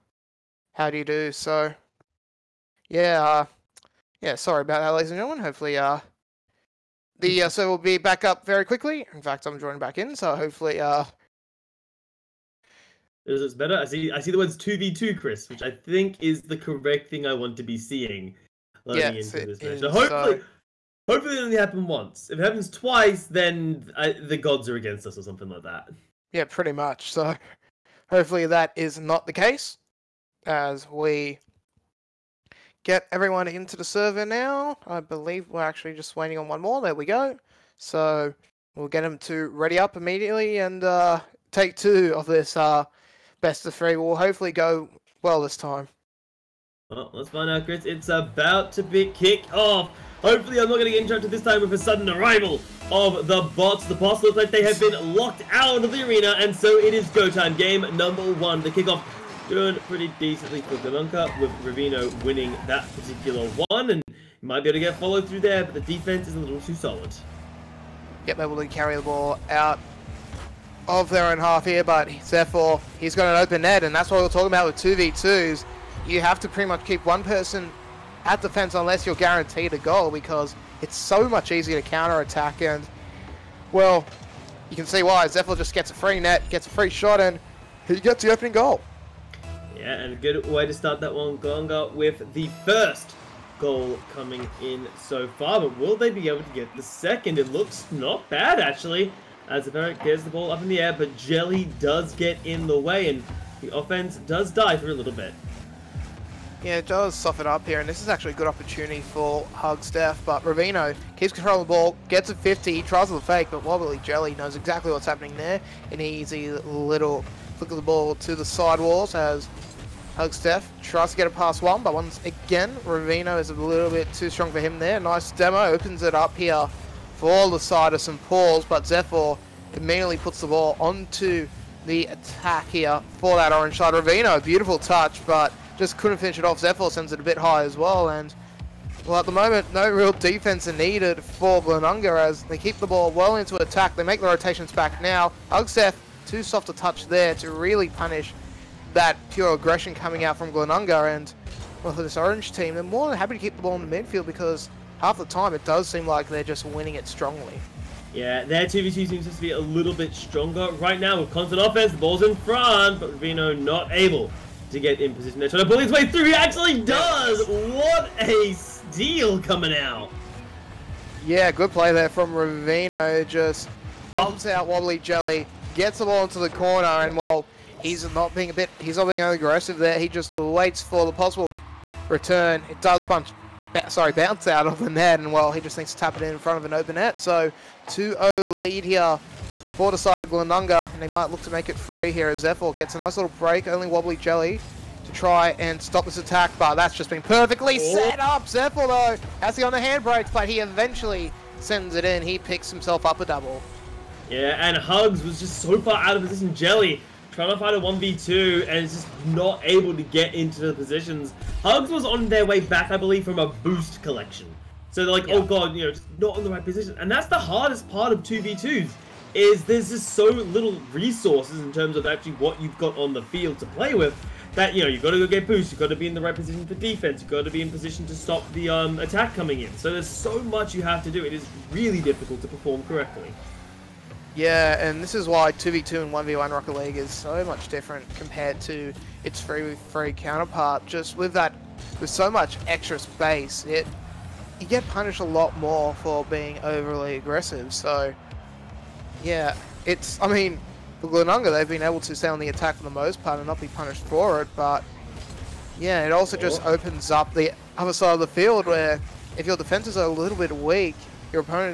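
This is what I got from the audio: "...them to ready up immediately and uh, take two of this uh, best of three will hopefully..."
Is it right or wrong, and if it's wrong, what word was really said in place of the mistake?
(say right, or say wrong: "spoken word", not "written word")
right.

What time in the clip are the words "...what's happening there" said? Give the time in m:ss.
1:54.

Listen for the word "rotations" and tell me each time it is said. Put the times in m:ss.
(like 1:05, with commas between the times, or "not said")
2:24.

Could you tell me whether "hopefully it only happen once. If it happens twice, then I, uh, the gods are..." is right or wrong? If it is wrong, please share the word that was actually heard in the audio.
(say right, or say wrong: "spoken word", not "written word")
right.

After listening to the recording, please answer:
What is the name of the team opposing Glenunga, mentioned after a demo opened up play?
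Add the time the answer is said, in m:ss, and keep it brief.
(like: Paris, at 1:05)
St. Paul's, at 2:07.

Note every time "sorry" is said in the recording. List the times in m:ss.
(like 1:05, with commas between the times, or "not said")
0:04, 3:03.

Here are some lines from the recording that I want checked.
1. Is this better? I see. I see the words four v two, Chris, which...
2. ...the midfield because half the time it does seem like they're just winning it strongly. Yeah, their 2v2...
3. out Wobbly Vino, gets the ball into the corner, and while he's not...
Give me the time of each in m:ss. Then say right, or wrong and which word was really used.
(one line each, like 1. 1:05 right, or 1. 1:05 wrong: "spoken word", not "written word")
1. 0:13 wrong: "two", not "four"
2. 2:33 right
3. 2:54 wrong: "Jelly", not "Vino".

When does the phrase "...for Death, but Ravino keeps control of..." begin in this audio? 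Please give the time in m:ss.
1:49.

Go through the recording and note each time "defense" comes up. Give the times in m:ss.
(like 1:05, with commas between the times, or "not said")
1:05, 1:18, 2:20, 3:46, 4:19.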